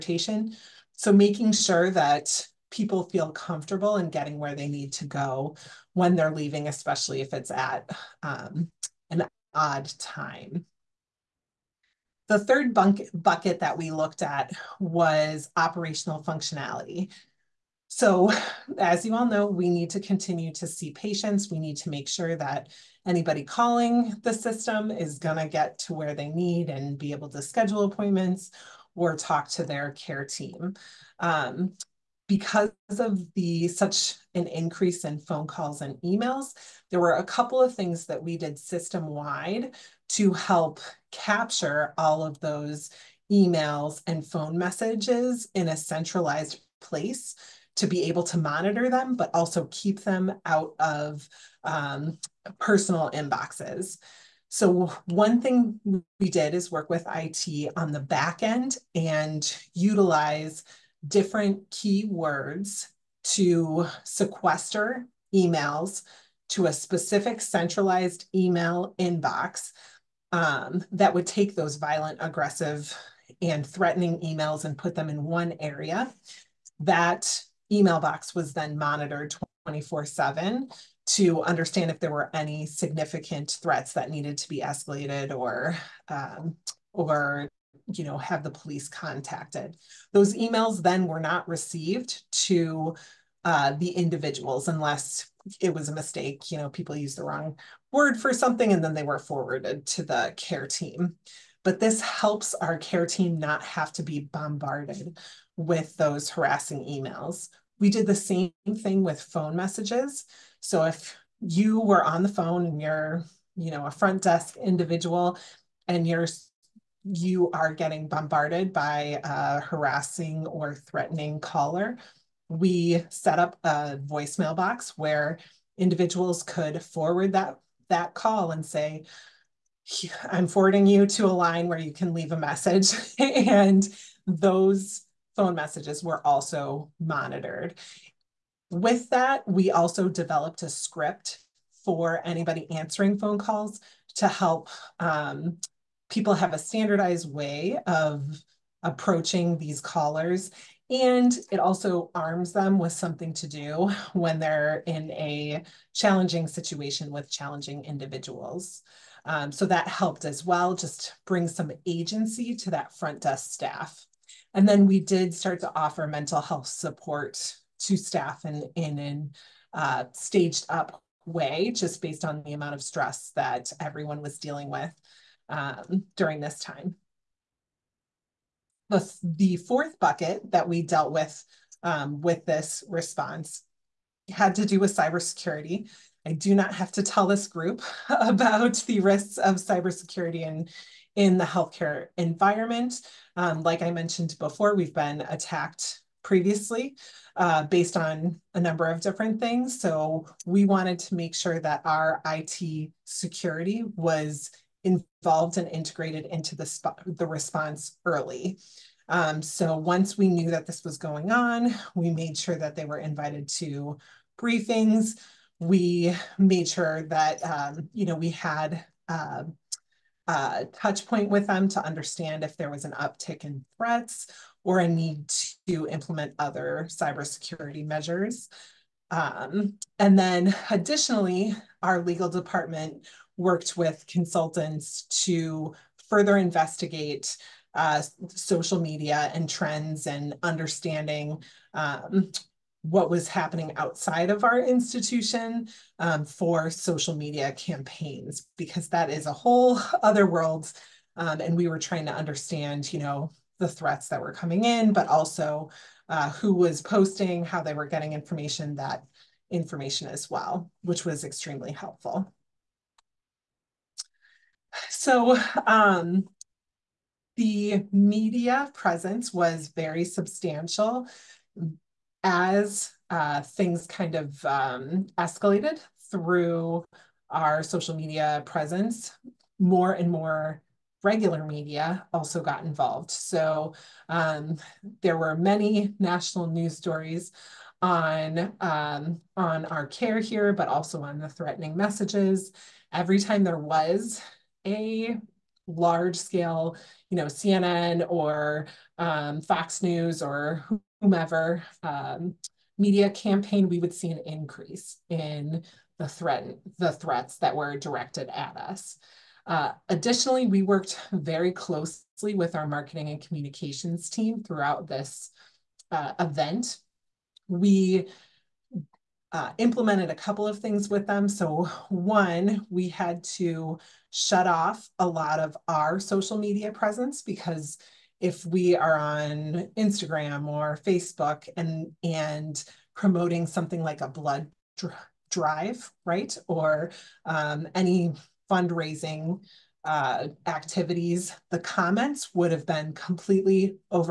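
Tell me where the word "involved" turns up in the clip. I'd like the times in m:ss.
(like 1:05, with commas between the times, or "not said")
3:24, 4:42.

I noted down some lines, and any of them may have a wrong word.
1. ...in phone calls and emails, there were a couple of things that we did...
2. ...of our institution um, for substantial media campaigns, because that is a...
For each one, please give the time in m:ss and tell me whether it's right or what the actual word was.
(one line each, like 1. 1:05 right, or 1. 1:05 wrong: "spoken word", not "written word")
1. 0:35 right
2. 4:04 wrong: "social", not "substantial".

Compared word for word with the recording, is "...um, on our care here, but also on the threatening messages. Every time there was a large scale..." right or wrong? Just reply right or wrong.
right.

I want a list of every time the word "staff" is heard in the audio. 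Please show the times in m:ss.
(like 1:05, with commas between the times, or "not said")
2:43, 2:47.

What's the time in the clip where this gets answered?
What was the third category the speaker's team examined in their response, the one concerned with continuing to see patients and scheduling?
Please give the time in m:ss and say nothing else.
0:15.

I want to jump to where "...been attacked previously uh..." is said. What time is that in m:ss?
3:14.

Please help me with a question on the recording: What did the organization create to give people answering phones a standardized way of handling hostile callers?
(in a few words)
A script.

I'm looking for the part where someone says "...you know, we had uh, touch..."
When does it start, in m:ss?
3:37.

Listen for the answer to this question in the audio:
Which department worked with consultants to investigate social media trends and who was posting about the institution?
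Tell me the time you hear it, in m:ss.
3:52.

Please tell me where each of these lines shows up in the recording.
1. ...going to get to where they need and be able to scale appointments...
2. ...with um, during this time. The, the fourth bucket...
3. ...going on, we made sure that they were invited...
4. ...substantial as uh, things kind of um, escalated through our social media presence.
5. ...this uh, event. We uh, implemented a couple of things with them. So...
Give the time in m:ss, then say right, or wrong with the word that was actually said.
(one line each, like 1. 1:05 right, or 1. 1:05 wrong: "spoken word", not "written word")
1. 0:25 wrong: "schedule", not "scale"
2. 2:54 right
3. 3:30 right
4. 4:30 right
5. 5:14 right.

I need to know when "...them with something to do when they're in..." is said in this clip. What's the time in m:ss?
2:32.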